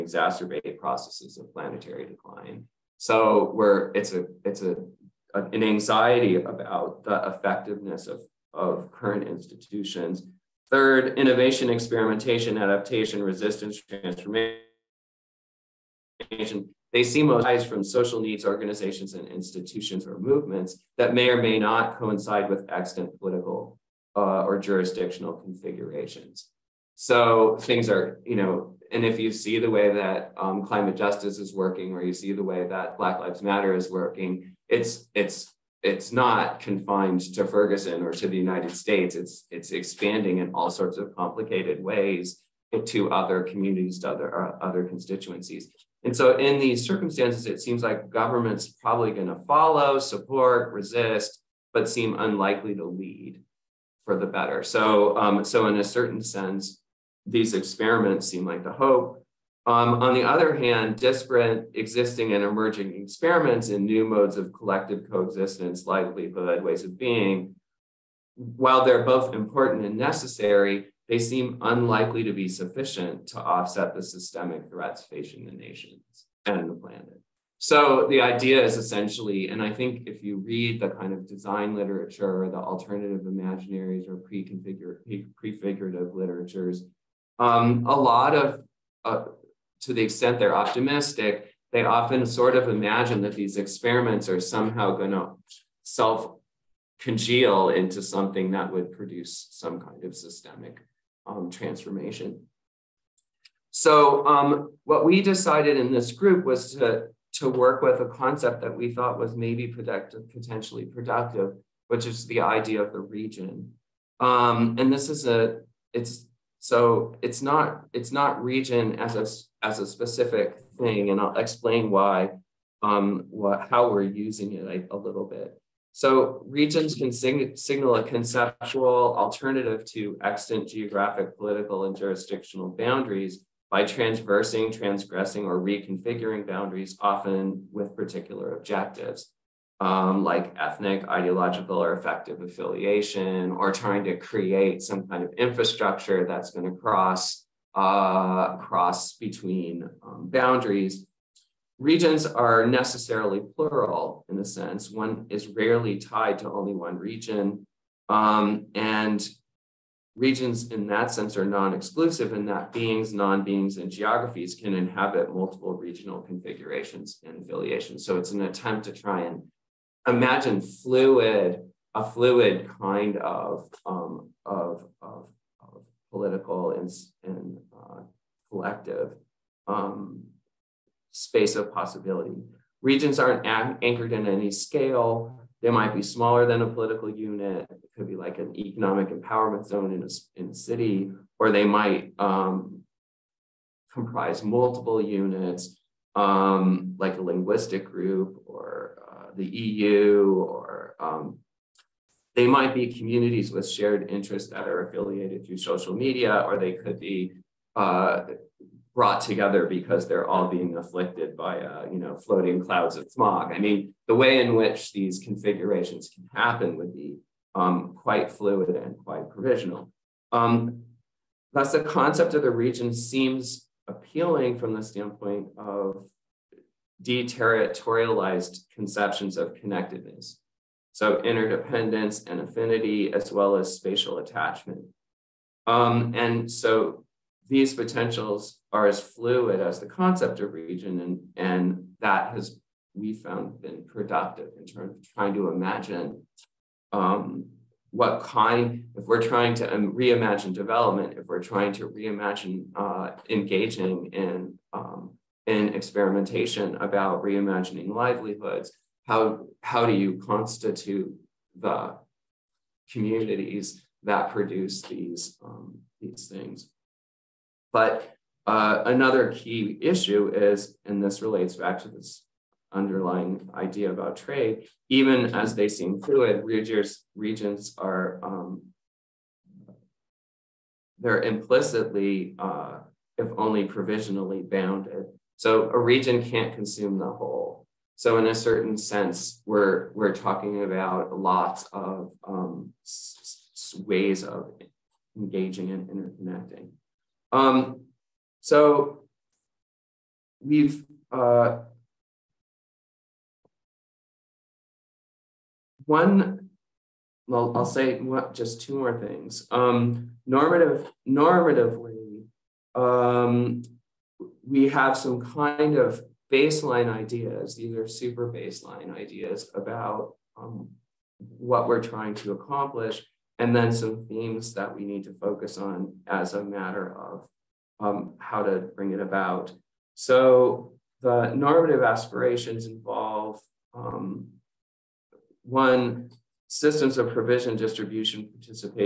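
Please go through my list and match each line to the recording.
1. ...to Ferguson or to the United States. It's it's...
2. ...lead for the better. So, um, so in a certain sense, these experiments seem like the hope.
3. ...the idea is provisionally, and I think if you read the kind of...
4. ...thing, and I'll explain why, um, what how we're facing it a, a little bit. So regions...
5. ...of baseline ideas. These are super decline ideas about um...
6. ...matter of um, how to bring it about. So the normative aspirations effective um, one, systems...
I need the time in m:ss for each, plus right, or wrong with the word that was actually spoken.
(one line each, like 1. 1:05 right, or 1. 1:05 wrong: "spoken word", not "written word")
1. 0:37 right
2. 0:52 right
3. 1:18 wrong: "essentially", not "provisionally"
4. 2:00 wrong: "using", not "facing"
5. 5:15 wrong: "baseline", not "decline"
6. 5:26 wrong: "involve", not "effective".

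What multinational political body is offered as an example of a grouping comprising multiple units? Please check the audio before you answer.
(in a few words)
the EU.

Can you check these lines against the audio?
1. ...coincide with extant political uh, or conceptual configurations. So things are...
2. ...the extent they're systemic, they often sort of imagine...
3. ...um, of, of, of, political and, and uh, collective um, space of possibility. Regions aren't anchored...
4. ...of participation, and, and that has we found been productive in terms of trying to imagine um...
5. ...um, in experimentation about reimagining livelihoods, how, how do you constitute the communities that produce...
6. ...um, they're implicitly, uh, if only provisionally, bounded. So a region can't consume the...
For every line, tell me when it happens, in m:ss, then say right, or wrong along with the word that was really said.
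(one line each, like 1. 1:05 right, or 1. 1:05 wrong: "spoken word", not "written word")
1. 0:21 wrong: "jurisdictional", not "conceptual"
2. 1:29 wrong: "optimistic", not "systemic"
3. 2:53 right
4. 4:00 wrong: "region", not "participation"
5. 4:14 right
6. 4:38 right.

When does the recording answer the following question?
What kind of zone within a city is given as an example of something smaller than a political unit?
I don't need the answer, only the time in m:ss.
3:08.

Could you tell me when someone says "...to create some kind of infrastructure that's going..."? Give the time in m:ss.
2:24.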